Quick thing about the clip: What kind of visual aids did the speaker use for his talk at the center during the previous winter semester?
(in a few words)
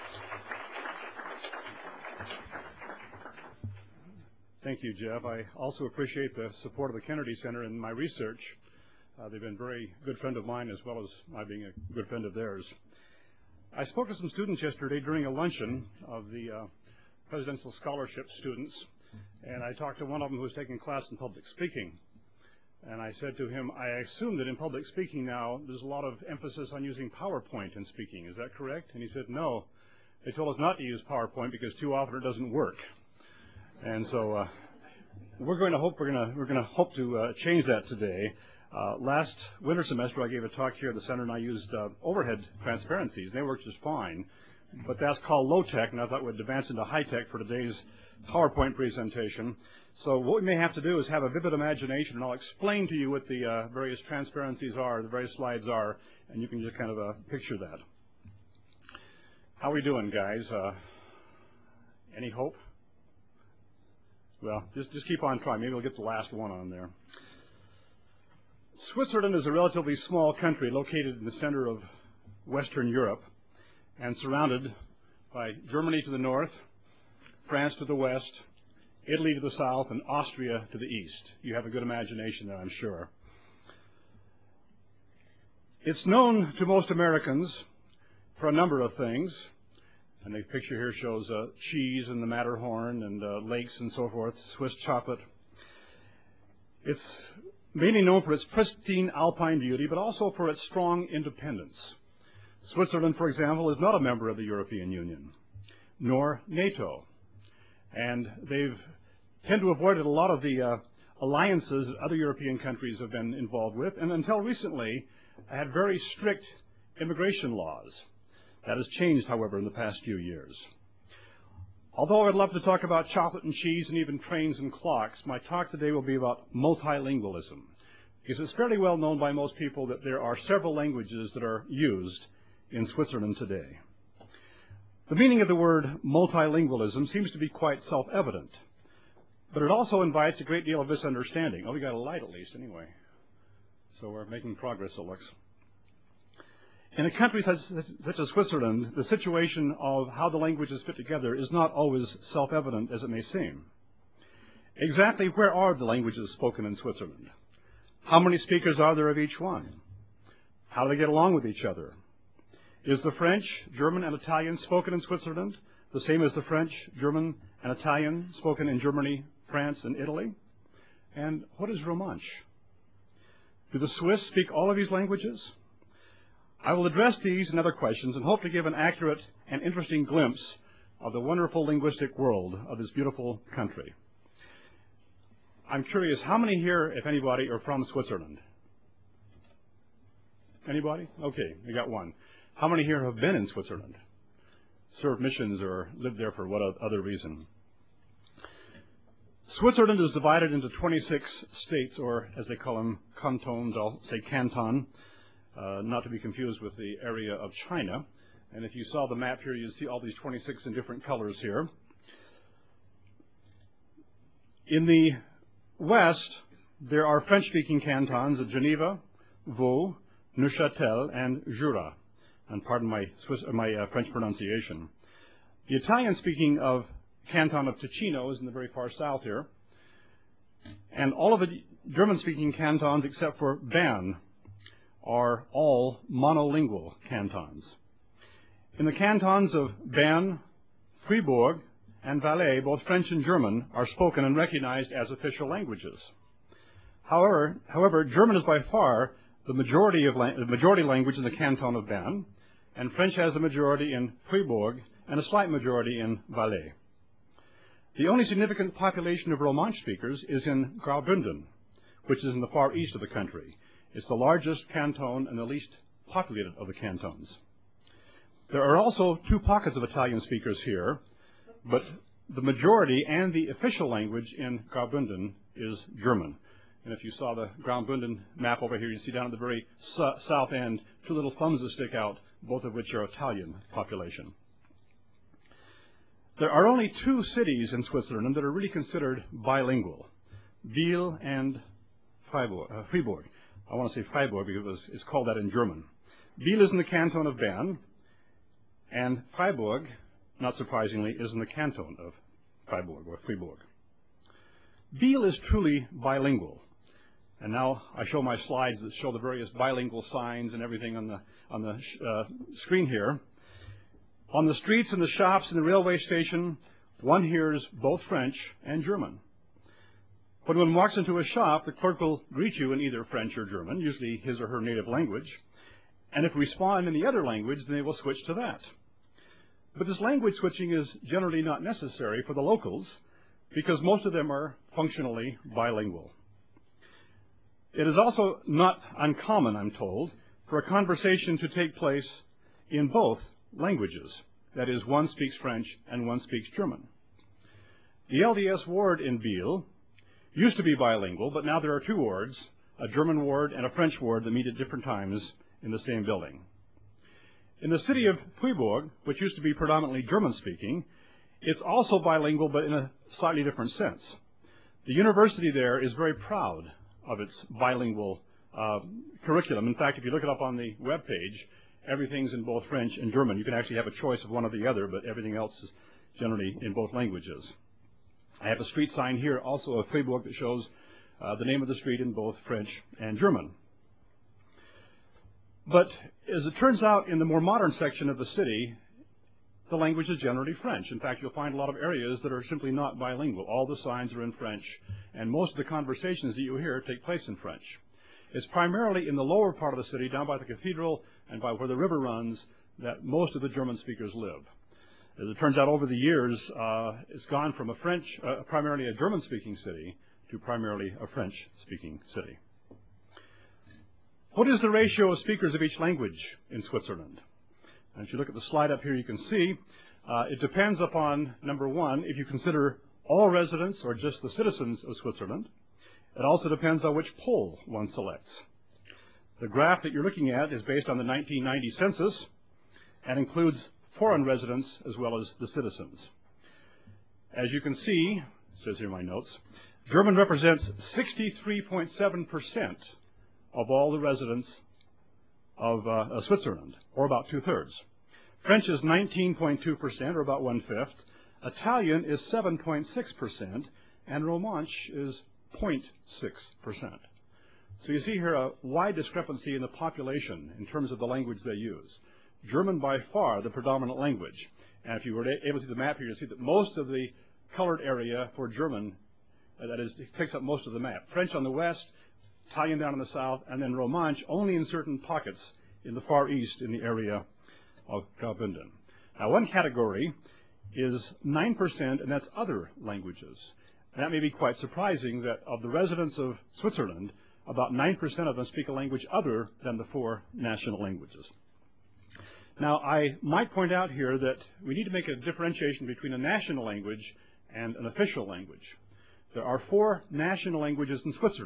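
overhead transparencies.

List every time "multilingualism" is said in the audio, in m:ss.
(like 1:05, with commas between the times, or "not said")
2:06, 2:16.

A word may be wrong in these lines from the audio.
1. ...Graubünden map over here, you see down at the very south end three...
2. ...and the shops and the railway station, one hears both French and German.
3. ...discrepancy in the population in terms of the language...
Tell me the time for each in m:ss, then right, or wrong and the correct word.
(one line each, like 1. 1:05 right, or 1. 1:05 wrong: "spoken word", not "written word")
1. 4:37 wrong: "two", not "three"
2. 5:14 right
3. 7:38 right.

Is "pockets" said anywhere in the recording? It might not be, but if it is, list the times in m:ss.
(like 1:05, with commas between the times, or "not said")
4:29, 7:54.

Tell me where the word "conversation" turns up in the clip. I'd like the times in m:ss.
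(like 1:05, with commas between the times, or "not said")
5:40, 6:35.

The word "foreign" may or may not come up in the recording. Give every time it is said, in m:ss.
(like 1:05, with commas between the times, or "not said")
7:13.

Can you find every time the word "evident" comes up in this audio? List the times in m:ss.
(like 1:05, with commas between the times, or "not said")
2:17, 2:32.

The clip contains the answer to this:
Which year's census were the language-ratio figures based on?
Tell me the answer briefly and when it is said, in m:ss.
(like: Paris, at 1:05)
1990, at 7:11.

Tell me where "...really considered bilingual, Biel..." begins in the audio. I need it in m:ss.
4:48.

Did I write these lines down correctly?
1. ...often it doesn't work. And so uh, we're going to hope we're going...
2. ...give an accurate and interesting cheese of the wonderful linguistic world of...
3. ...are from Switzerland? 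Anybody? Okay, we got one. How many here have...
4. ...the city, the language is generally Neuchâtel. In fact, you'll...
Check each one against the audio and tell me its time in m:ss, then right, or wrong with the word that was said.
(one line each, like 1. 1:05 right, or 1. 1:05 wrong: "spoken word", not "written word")
1. 0:31 right
2. 2:58 wrong: "glimpse", not "cheese"
3. 3:07 right
4. 6:28 wrong: "French", not "Neuchâtel".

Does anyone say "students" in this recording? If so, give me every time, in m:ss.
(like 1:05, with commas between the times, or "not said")
0:14, 0:18.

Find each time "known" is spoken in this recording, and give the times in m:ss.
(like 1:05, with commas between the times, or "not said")
1:26, 1:38, 2:08.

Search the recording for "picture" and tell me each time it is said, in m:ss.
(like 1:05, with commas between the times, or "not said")
0:57, 1:30.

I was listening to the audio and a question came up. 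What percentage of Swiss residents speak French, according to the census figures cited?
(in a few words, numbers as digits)
19.2%.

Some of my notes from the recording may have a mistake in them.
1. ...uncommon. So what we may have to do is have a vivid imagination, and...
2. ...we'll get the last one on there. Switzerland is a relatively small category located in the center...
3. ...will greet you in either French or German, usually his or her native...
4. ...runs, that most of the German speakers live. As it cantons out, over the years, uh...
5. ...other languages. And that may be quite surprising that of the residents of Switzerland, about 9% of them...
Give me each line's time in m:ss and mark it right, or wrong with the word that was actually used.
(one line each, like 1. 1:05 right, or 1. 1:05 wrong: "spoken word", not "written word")
1. 0:48 wrong: "presentation", not "uncommon"
2. 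1:05 wrong: "country", not "category"
3. 5:21 right
4. 6:41 wrong: "turns", not "cantons"
5. 8:02 right.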